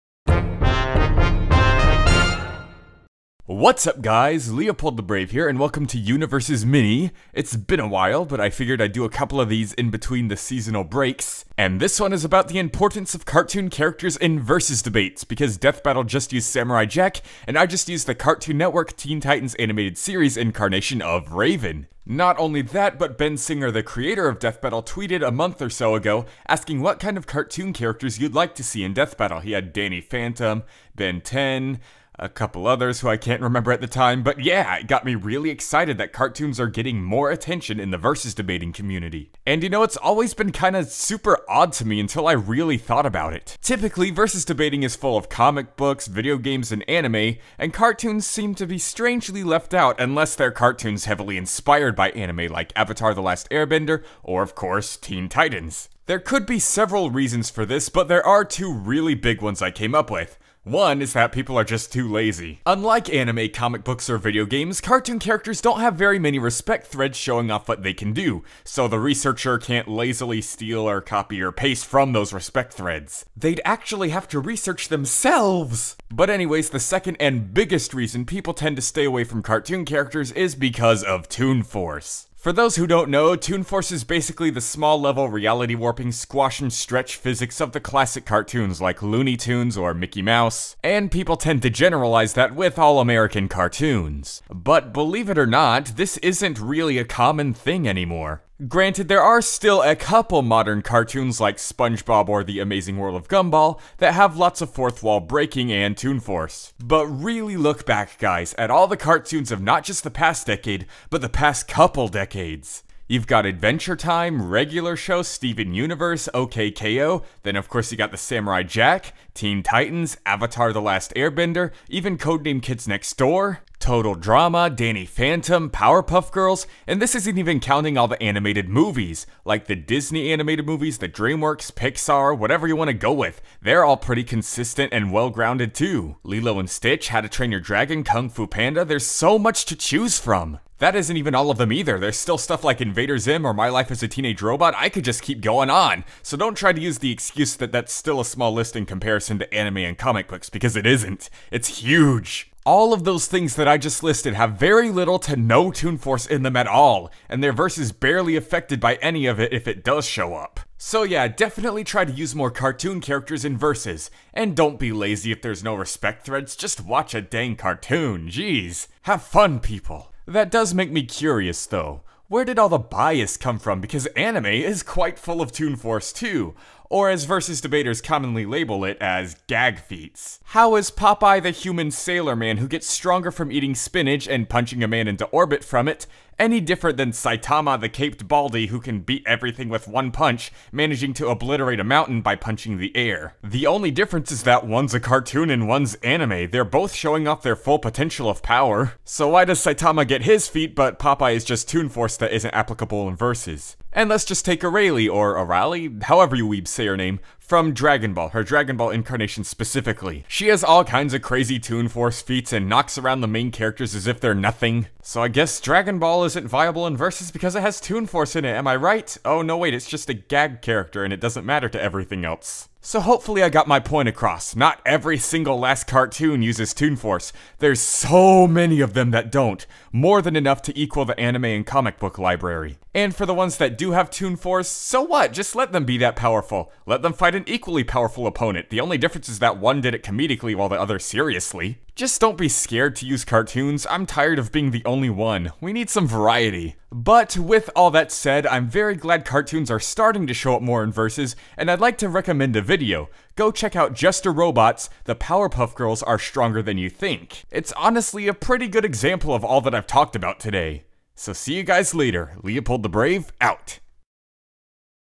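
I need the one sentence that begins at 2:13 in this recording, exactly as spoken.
They're all pretty consistent and well grounded too.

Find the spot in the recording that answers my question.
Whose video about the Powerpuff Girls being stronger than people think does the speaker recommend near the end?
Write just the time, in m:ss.
4:13.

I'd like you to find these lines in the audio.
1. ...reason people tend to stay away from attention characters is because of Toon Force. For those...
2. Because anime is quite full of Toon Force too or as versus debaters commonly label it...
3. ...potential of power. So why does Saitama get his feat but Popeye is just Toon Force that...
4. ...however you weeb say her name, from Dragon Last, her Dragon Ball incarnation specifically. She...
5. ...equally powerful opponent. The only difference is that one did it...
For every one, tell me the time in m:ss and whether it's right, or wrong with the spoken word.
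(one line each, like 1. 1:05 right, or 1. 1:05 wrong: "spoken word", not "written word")
1. 1:17 wrong: "cartoon", not "attention"
2. 2:53 right
3. 3:17 right
4. 3:26 wrong: "Ball", not "Last"
5. 3:57 right.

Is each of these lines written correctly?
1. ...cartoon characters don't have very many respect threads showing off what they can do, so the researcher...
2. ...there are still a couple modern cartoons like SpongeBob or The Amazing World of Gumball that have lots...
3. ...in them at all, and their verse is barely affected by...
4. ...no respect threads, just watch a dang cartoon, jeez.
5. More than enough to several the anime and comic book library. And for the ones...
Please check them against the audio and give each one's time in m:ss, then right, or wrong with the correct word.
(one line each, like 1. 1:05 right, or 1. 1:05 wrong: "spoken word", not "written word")
1. 1:04 right
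2. 1:39 right
3. 2:36 right
4. 2:45 right
5. 3:49 wrong: "equal", not "several".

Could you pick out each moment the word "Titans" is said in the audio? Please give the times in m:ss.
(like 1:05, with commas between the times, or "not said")
0:19, 0:55, 1:59.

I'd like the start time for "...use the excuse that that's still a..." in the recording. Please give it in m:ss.
2:26.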